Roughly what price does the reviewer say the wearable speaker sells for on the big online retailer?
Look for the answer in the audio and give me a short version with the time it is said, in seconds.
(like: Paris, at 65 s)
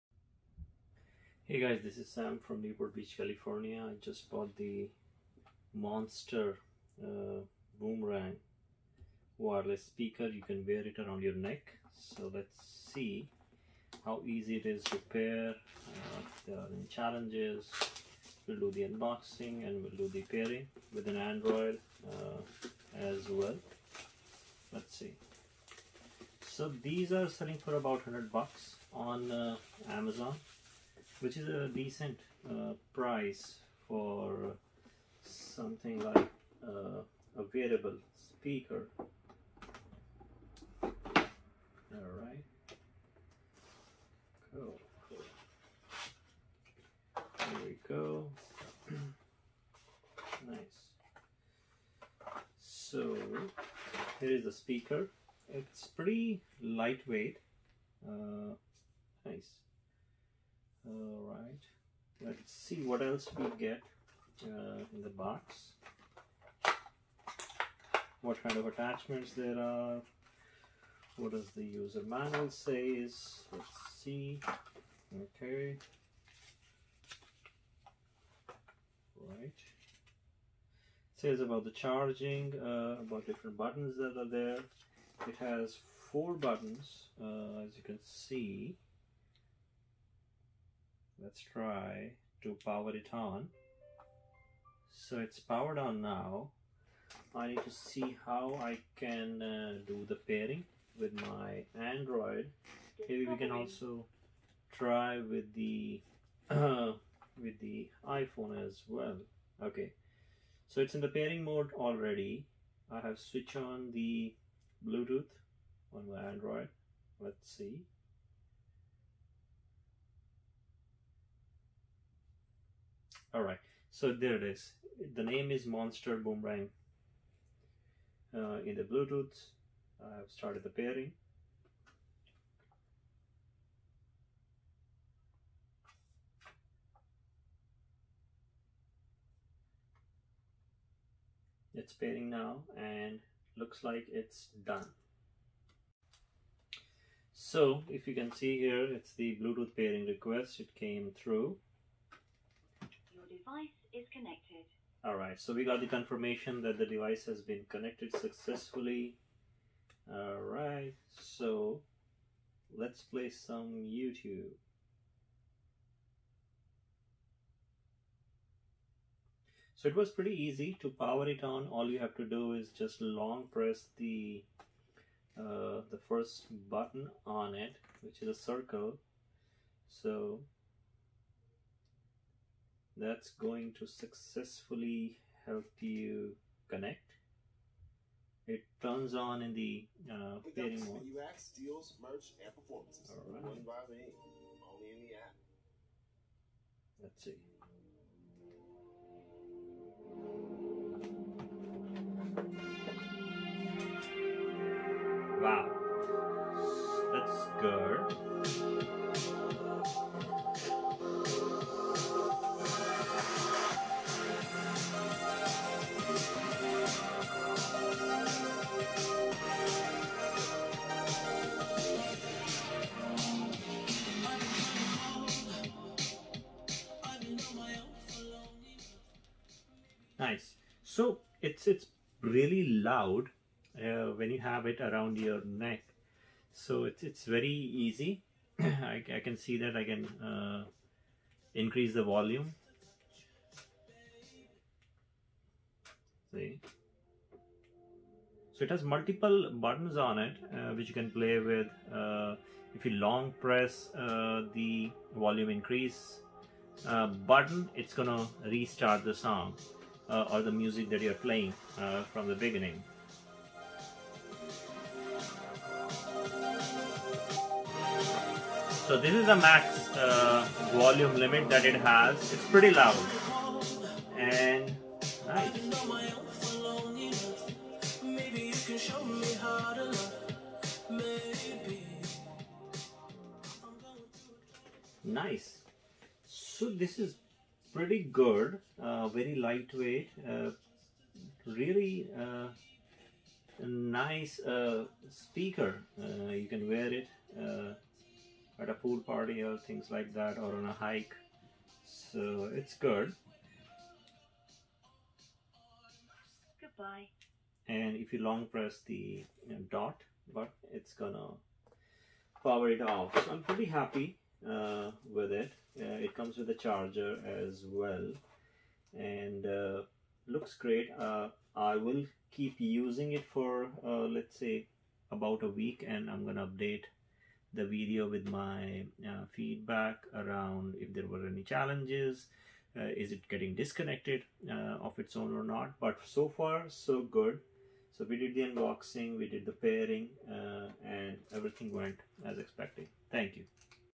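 $100, at 28 s.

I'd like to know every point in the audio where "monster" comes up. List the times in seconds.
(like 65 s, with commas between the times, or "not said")
5 s, 125 s.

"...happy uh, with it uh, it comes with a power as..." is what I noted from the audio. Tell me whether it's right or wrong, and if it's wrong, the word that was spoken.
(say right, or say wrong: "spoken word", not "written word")
wrong: "charger", not "power".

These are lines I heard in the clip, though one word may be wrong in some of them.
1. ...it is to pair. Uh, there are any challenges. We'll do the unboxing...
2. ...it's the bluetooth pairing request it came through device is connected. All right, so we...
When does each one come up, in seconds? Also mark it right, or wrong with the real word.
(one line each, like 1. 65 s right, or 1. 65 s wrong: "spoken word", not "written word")
1. 14 s right
2. 148 s right.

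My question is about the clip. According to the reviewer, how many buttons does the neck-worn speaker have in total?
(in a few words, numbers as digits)
4.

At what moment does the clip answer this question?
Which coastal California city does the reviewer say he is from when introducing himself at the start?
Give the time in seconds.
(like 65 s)
2 s.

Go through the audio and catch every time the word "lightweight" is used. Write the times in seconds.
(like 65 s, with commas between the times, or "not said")
56 s, 289 s.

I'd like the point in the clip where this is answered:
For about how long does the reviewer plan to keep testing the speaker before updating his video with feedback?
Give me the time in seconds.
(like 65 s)
325 s.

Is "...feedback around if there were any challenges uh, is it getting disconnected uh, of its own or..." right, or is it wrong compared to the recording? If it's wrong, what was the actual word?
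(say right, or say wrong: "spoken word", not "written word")
right.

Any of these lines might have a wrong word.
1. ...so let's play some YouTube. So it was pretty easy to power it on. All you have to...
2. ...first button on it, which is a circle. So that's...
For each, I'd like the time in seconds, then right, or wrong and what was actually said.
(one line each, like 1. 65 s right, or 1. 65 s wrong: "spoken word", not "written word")
1. 161 s right
2. 176 s right.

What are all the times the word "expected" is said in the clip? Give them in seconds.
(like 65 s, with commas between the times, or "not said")
342 s.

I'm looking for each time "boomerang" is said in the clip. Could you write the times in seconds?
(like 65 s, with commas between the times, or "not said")
7 s, 126 s.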